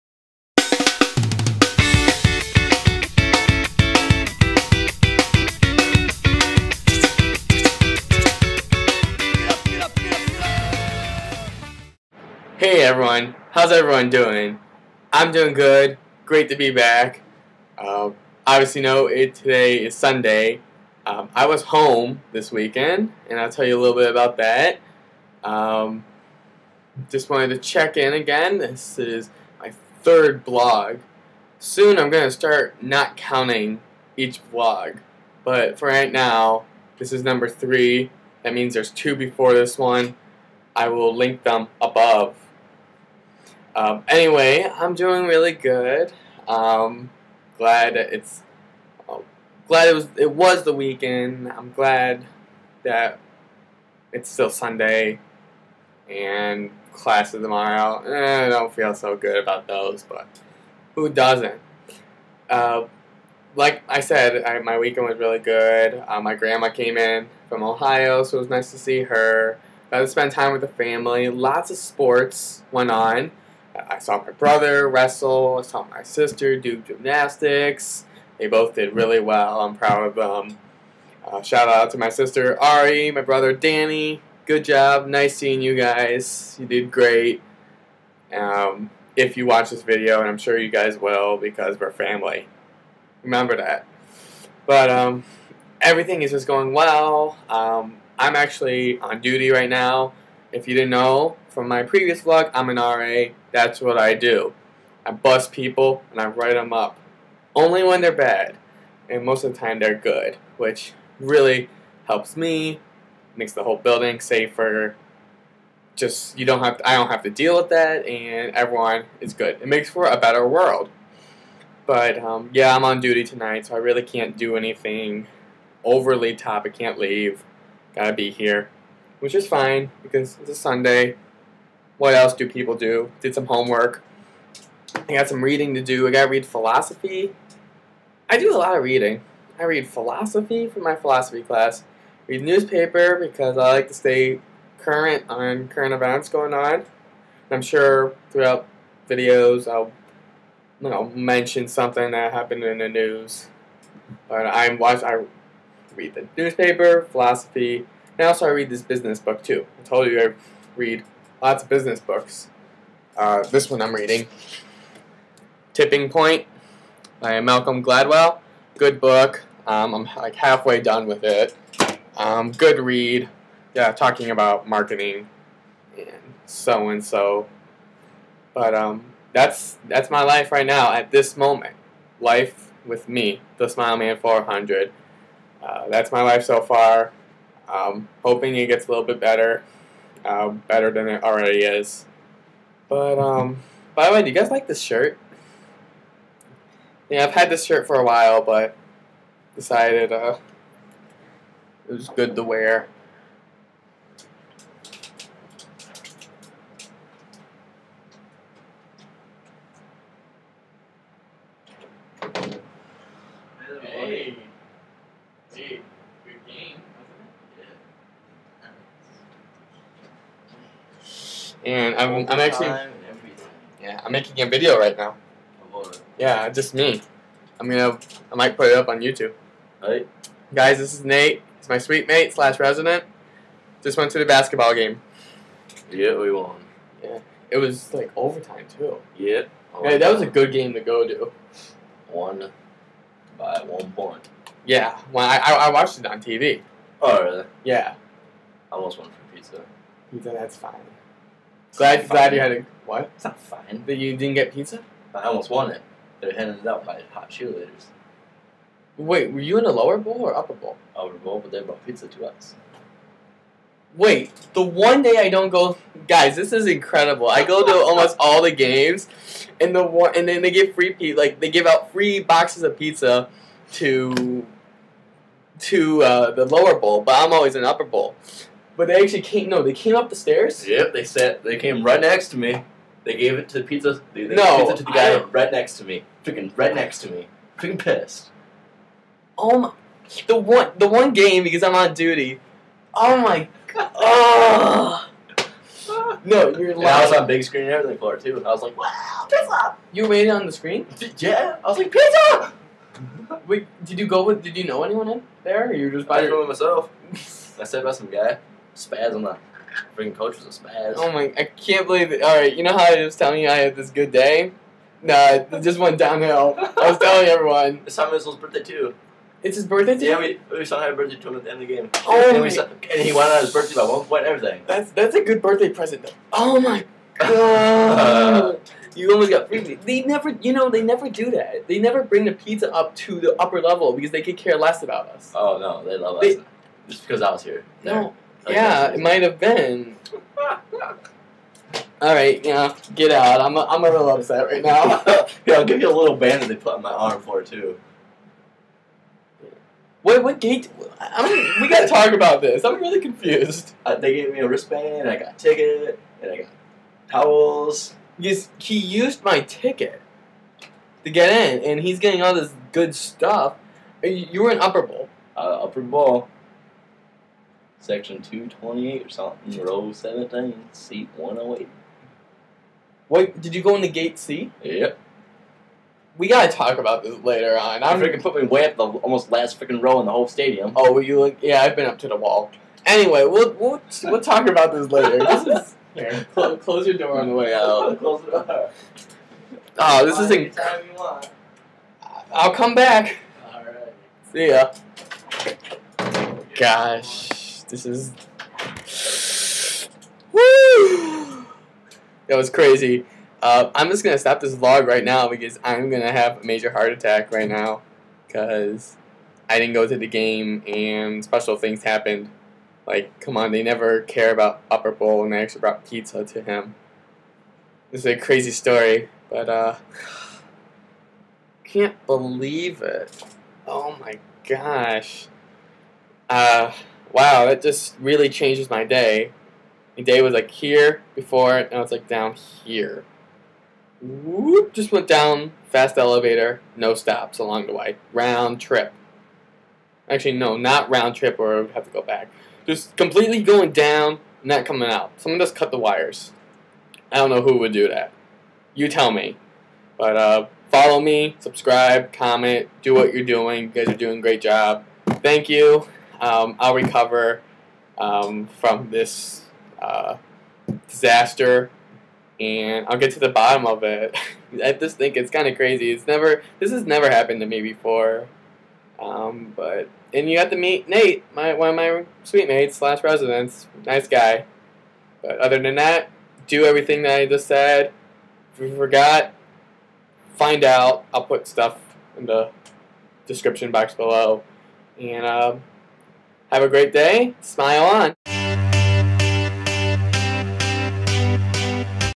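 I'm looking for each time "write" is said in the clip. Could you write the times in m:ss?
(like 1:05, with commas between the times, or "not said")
1:46.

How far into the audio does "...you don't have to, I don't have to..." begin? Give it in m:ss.
1:56.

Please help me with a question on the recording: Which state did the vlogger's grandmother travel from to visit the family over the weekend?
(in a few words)
Ohio.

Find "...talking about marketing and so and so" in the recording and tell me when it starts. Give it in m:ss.
2:53.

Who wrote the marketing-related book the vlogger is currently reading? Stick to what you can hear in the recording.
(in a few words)
Malcolm Gladwell.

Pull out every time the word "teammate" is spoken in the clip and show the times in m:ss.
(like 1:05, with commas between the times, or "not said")
not said.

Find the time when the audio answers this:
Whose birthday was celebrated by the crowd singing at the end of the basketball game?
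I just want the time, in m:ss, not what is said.
5:17.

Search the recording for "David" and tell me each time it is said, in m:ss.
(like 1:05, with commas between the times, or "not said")
not said.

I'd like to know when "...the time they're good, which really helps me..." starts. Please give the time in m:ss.
1:49.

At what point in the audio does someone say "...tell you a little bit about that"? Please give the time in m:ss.
0:23.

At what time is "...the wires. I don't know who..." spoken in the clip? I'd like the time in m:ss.
7:25.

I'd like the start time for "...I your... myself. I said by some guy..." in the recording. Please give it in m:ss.
5:06.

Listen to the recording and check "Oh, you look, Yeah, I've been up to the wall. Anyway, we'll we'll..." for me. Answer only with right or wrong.
right.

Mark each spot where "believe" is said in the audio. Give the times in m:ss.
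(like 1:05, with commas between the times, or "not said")
5:11, 7:02.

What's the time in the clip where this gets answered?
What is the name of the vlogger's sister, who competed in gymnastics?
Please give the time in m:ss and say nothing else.
1:22.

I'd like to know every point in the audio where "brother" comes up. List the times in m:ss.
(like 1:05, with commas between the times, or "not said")
1:14, 1:23.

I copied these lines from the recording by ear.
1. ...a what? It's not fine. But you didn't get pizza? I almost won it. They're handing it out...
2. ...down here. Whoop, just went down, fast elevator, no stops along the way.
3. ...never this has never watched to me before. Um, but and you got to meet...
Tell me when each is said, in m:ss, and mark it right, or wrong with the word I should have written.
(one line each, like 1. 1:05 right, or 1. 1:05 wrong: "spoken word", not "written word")
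1. 4:12 right
2. 7:12 right
3. 7:46 wrong: "happened", not "watched".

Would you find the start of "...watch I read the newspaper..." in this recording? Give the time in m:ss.
2:34.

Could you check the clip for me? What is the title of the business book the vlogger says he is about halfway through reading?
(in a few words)
Tipping Point.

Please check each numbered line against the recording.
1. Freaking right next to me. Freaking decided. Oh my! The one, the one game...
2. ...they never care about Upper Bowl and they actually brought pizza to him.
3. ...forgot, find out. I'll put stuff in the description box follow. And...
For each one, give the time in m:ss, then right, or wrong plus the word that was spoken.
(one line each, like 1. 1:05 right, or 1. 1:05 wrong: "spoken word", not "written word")
1. 4:46 wrong: "pissed", not "decided"
2. 6:53 right
3. 7:58 wrong: "below", not "follow".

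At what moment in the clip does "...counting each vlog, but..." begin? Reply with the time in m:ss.
0:33.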